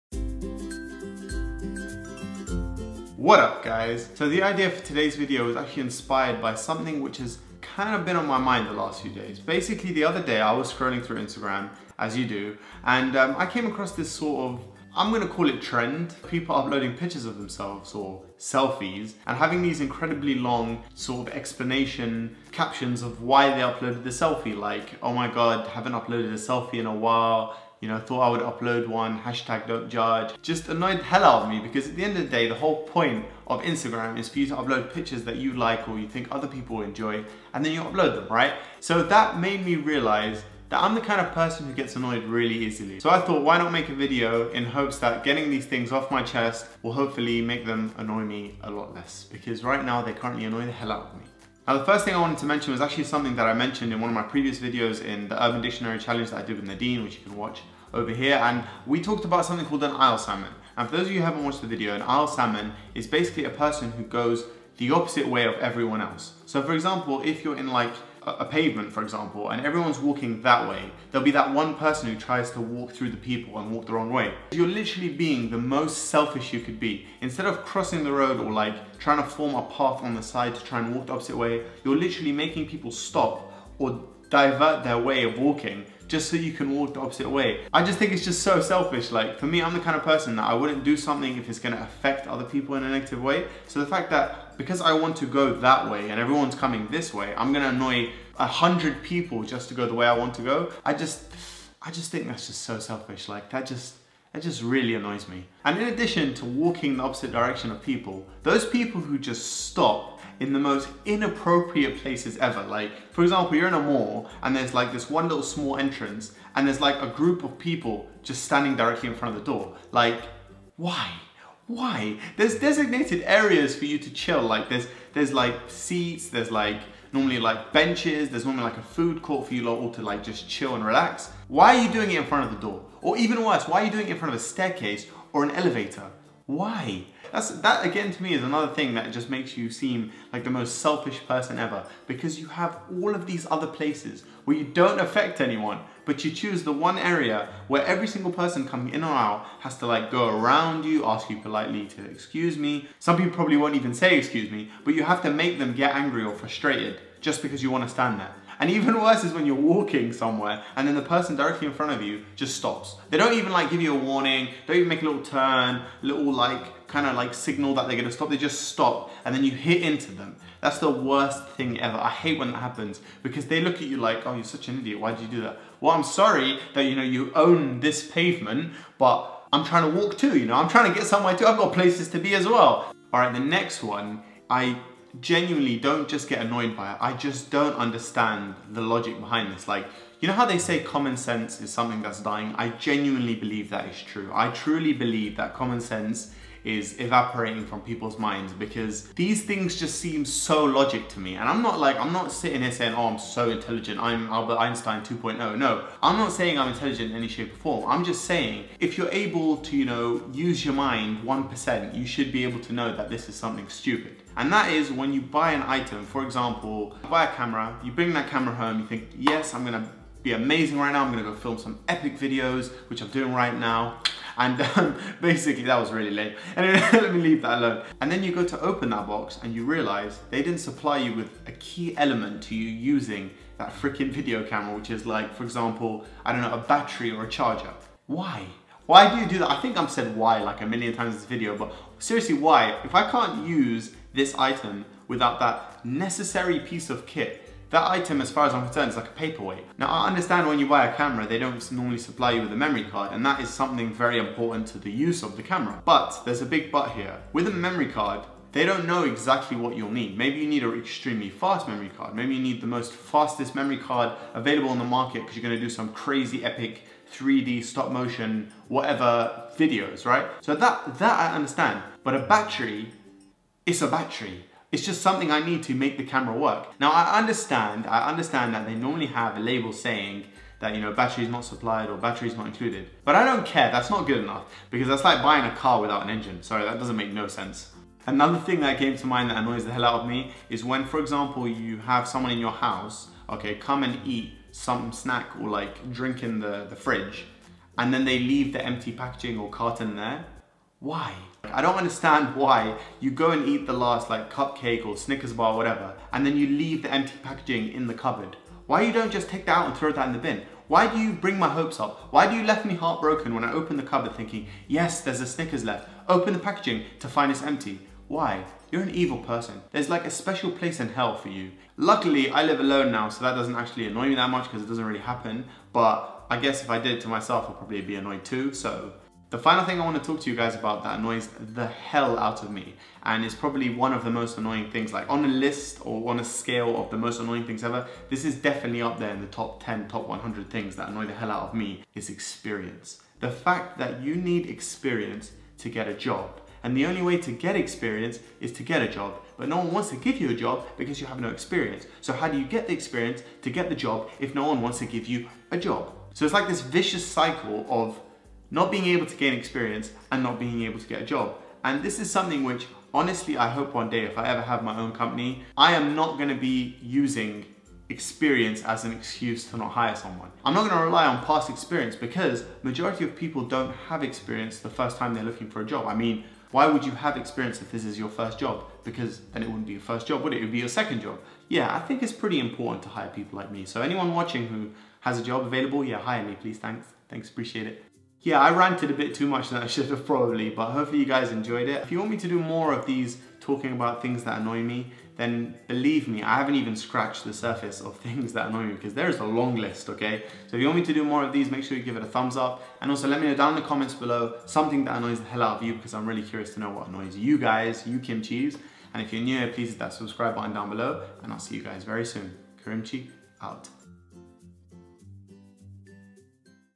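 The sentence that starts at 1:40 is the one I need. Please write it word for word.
I just, I just think that's just so selfish.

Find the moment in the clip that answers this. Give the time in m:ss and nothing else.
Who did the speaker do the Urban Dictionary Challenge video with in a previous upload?
0:56.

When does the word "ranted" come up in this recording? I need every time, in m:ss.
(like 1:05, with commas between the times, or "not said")
6:28.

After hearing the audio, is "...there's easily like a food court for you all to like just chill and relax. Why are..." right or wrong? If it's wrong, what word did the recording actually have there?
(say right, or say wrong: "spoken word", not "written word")
wrong: "normally", not "easily".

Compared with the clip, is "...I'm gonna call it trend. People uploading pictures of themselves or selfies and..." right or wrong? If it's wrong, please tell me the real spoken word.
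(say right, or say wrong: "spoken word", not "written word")
right.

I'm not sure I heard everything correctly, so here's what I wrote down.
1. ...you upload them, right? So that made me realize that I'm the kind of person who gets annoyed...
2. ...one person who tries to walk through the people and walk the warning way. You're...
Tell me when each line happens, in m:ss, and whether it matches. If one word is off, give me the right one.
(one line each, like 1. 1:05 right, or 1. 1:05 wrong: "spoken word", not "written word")
1. 0:37 right
2. 1:11 wrong: "wrong", not "warning".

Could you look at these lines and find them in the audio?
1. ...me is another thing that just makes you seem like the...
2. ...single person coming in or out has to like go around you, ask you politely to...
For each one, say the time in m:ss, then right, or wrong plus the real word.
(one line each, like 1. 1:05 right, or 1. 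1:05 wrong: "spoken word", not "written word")
1. 2:18 right
2. 2:28 right.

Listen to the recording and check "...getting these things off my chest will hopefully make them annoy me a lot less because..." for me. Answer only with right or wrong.
right.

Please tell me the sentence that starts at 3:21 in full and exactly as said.
And I'm not like, I'm not sitting here saying, oh, I'm so intelligent, I'm Albert Einstein 2.0.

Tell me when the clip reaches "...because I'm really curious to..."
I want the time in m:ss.
6:45.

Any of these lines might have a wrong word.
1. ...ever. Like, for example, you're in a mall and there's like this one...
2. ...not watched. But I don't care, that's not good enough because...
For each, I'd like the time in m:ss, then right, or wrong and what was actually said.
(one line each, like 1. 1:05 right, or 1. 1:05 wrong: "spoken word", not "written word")
1. 1:52 right
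2. 4:42 wrong: "included", not "watched".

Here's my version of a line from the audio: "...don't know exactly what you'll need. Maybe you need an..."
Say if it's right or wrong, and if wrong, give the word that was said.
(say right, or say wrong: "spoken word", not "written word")
right.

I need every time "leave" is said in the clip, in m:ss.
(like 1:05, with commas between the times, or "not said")
3:47, 4:58, 5:06.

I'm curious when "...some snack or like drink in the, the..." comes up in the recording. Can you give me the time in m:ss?
4:54.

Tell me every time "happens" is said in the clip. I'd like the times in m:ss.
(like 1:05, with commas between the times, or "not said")
2:52, 5:24.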